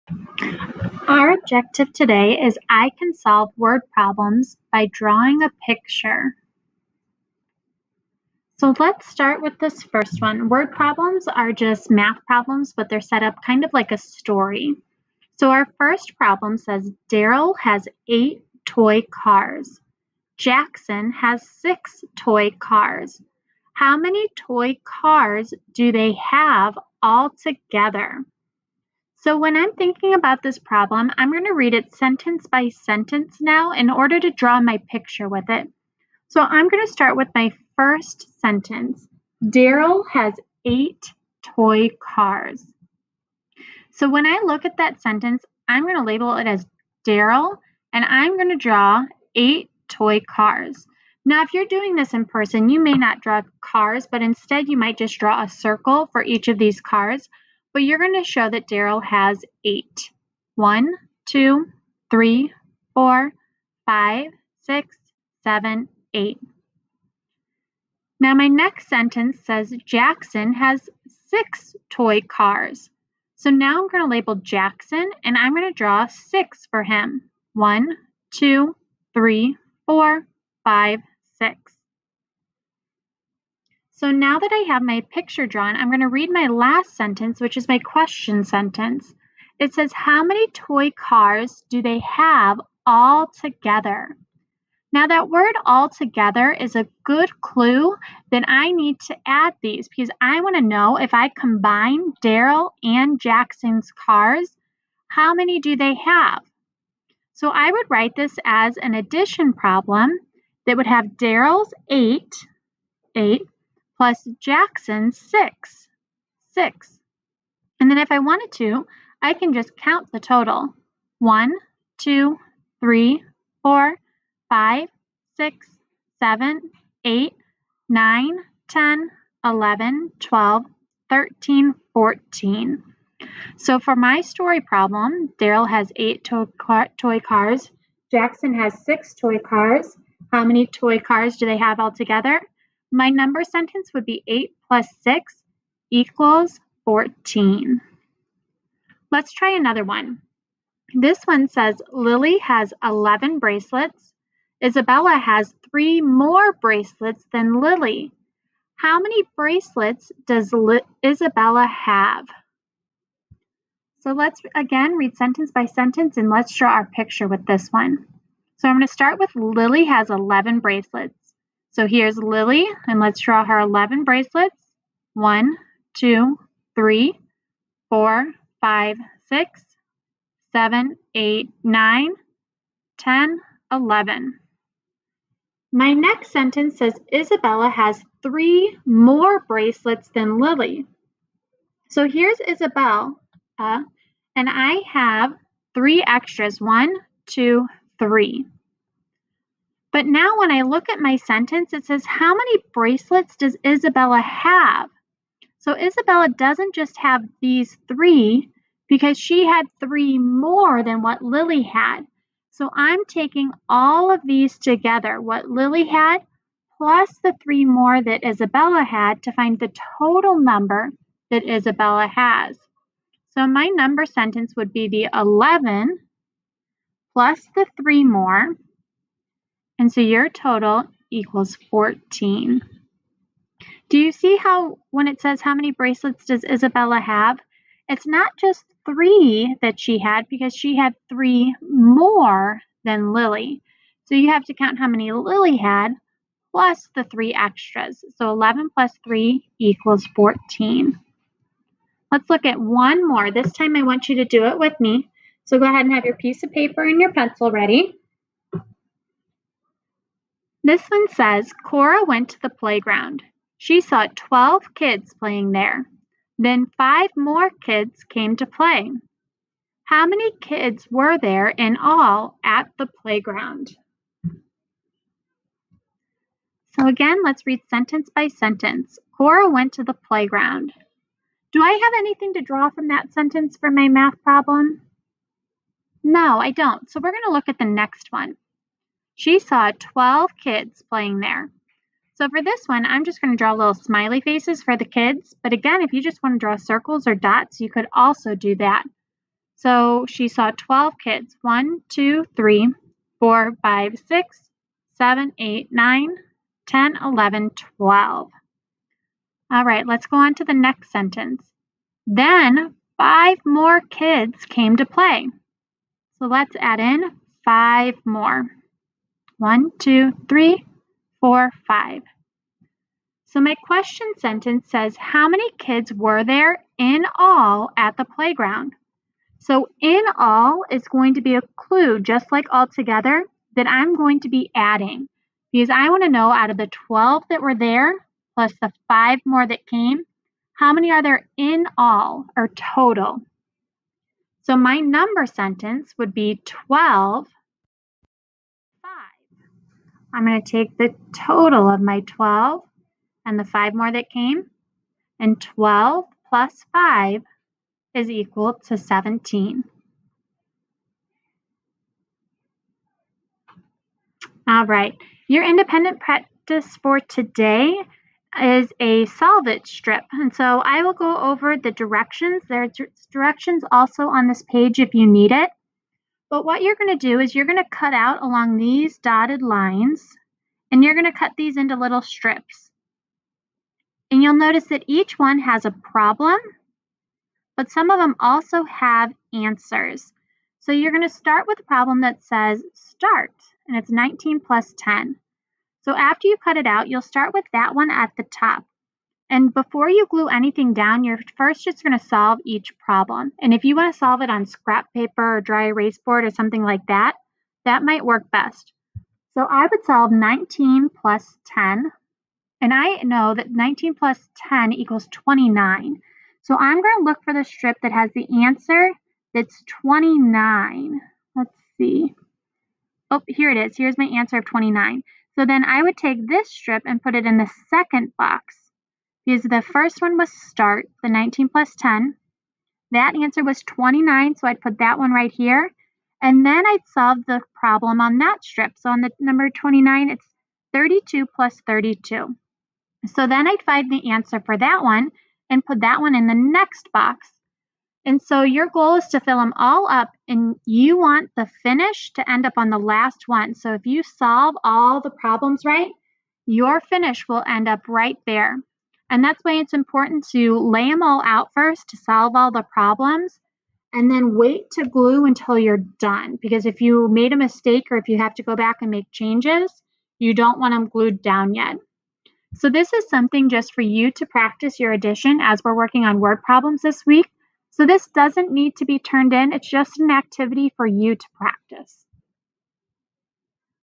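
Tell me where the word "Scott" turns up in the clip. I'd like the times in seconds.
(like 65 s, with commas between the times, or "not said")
not said.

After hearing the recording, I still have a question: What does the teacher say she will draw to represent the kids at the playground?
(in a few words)
smiley faces.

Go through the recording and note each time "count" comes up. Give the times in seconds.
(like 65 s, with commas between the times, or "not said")
119 s, 244 s.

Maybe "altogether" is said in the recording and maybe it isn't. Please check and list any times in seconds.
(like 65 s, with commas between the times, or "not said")
141 s, 332 s.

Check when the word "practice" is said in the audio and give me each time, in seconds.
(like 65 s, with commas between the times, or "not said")
365 s, 474 s, 481 s.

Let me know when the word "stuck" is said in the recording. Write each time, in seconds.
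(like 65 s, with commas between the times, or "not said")
not said.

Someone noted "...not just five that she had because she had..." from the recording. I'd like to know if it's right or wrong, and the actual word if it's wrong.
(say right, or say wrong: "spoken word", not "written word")
wrong: "three", not "five".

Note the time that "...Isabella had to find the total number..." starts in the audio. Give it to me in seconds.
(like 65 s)
218 s.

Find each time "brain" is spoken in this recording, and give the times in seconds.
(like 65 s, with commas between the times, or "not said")
not said.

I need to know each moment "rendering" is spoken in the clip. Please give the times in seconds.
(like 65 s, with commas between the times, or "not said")
not said.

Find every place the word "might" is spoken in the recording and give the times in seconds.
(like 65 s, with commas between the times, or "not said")
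54 s, 407 s.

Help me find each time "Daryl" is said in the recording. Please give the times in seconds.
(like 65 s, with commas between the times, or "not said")
17 s, 39 s, 47 s, 58 s, 102 s, 111 s, 135 s.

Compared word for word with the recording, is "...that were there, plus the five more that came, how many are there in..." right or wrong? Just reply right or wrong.
right.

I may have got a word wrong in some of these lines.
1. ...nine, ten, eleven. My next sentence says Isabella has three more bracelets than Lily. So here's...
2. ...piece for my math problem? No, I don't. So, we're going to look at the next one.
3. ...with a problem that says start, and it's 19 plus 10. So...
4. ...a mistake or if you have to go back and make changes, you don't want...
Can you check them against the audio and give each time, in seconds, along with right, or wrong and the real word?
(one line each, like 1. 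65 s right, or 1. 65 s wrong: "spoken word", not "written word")
1. 181 s right
2. 283 s wrong: "sentence", not "piece"
3. 391 s right
4. 467 s right.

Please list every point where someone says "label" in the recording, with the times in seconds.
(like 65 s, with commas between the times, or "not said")
46 s, 74 s.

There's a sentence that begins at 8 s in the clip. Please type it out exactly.
So let's start with this first one.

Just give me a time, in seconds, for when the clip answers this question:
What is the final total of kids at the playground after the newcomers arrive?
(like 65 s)
358 s.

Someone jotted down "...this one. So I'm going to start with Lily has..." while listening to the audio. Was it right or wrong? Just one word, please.
right.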